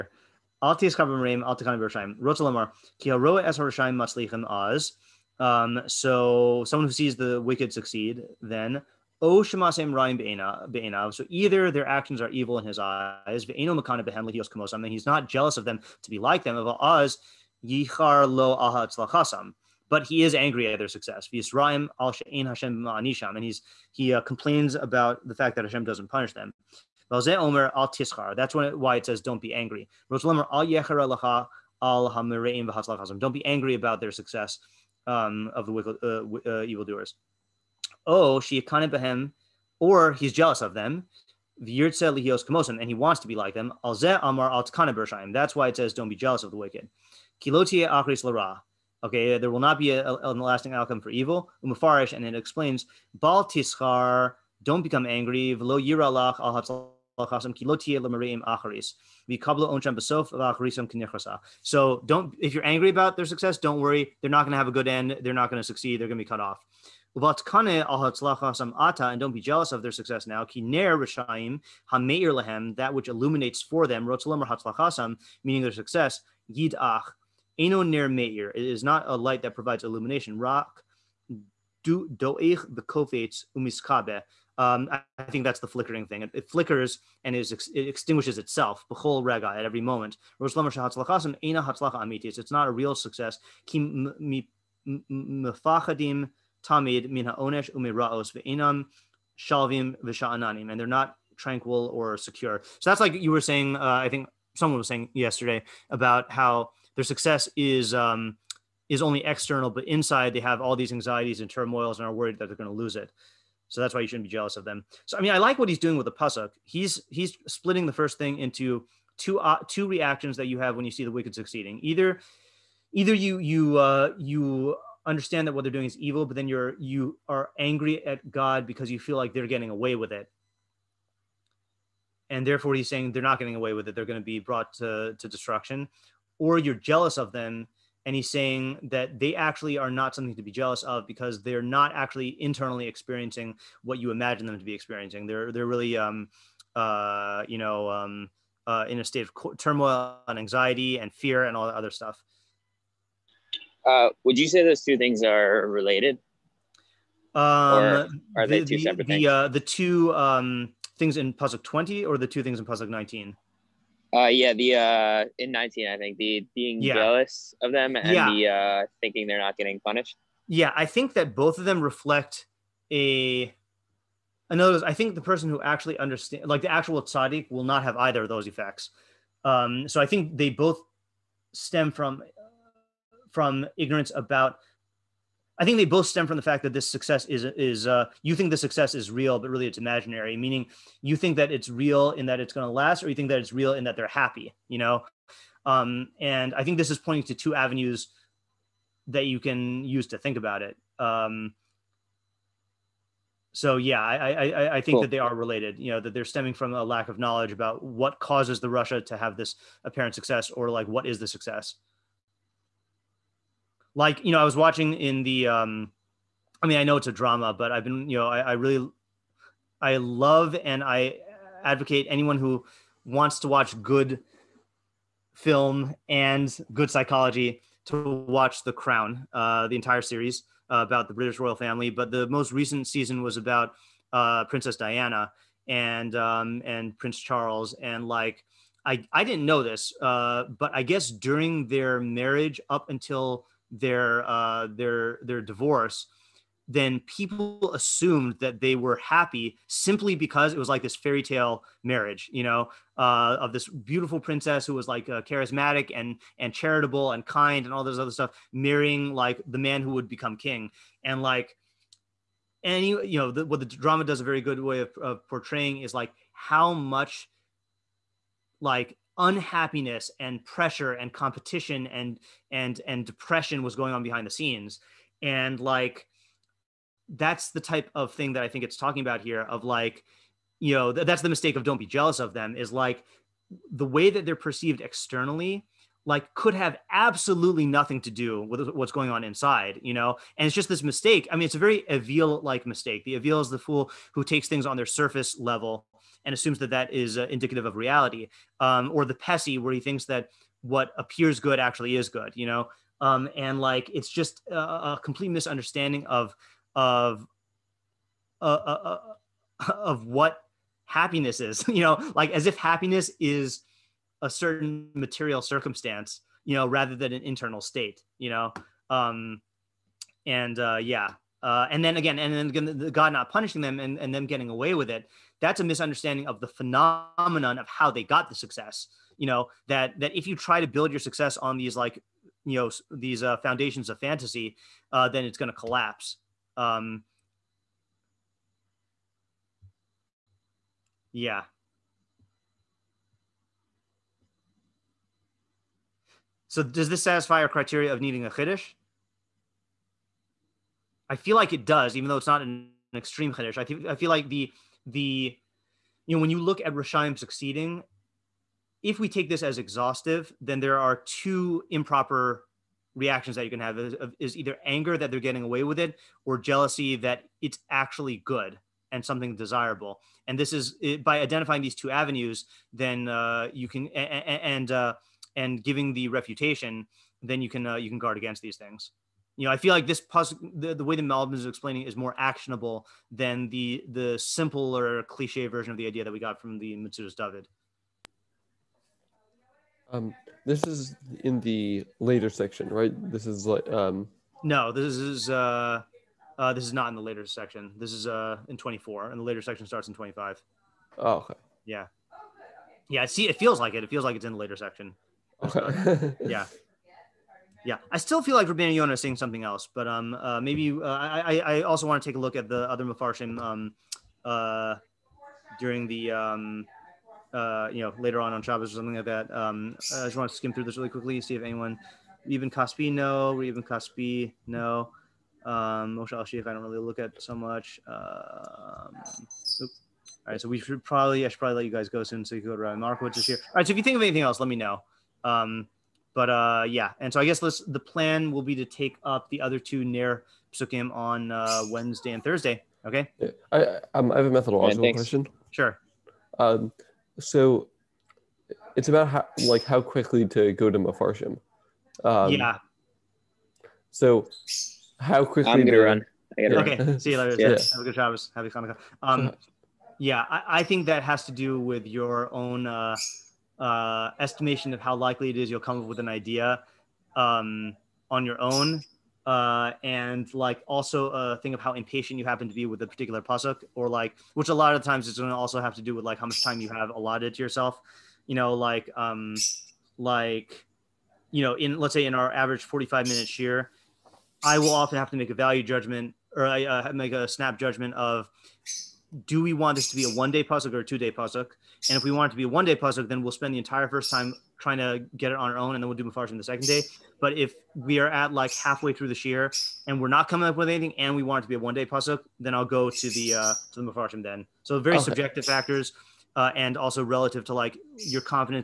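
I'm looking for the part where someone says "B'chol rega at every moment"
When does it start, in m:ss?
1:28.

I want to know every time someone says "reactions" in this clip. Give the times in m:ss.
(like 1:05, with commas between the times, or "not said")
1:59, 6:02.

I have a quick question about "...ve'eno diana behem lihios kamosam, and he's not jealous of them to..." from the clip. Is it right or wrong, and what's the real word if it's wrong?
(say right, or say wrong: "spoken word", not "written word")
wrong: "makana", not "diana".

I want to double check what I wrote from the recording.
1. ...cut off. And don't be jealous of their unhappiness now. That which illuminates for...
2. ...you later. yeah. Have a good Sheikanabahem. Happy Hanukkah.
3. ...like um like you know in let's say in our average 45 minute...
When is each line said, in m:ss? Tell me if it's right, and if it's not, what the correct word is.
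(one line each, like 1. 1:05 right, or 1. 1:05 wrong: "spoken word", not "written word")
1. 1:06 wrong: "success", not "unhappiness"
2. 7:37 wrong: "Shabbos", not "Sheikanabahem"
3. 7:58 right.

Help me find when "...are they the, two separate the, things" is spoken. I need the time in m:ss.
2:38.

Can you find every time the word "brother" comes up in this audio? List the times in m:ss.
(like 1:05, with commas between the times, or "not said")
not said.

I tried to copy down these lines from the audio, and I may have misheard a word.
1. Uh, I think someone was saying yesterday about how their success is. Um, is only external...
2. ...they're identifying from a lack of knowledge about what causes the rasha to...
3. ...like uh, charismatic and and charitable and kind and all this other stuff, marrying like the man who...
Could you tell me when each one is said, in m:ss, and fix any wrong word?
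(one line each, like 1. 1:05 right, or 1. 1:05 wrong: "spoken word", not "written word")
1. 1:43 right
2. 3:26 wrong: "stemming", not "identifying"
3. 4:14 right.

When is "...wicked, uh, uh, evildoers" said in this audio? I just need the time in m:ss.
0:35.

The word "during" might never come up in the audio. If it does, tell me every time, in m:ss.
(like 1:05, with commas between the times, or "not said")
4:01, 6:55.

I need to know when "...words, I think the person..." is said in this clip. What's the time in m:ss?
2:54.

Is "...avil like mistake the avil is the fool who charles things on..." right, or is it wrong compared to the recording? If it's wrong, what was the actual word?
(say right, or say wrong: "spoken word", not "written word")
wrong: "takes", not "charles".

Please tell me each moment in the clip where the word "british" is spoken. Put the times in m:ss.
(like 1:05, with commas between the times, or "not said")
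3:51.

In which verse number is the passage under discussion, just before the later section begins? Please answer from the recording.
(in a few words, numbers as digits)
24.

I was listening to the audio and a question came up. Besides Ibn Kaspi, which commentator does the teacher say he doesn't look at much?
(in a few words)
Moshe Alshich.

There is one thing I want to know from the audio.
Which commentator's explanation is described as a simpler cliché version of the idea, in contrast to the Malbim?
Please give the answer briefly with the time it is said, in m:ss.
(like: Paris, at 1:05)
Metzudas David, at 6:26.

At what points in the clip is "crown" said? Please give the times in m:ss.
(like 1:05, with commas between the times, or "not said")
3:48.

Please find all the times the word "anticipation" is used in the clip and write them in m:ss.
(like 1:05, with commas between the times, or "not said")
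not said.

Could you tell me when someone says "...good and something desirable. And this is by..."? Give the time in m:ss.
6:08.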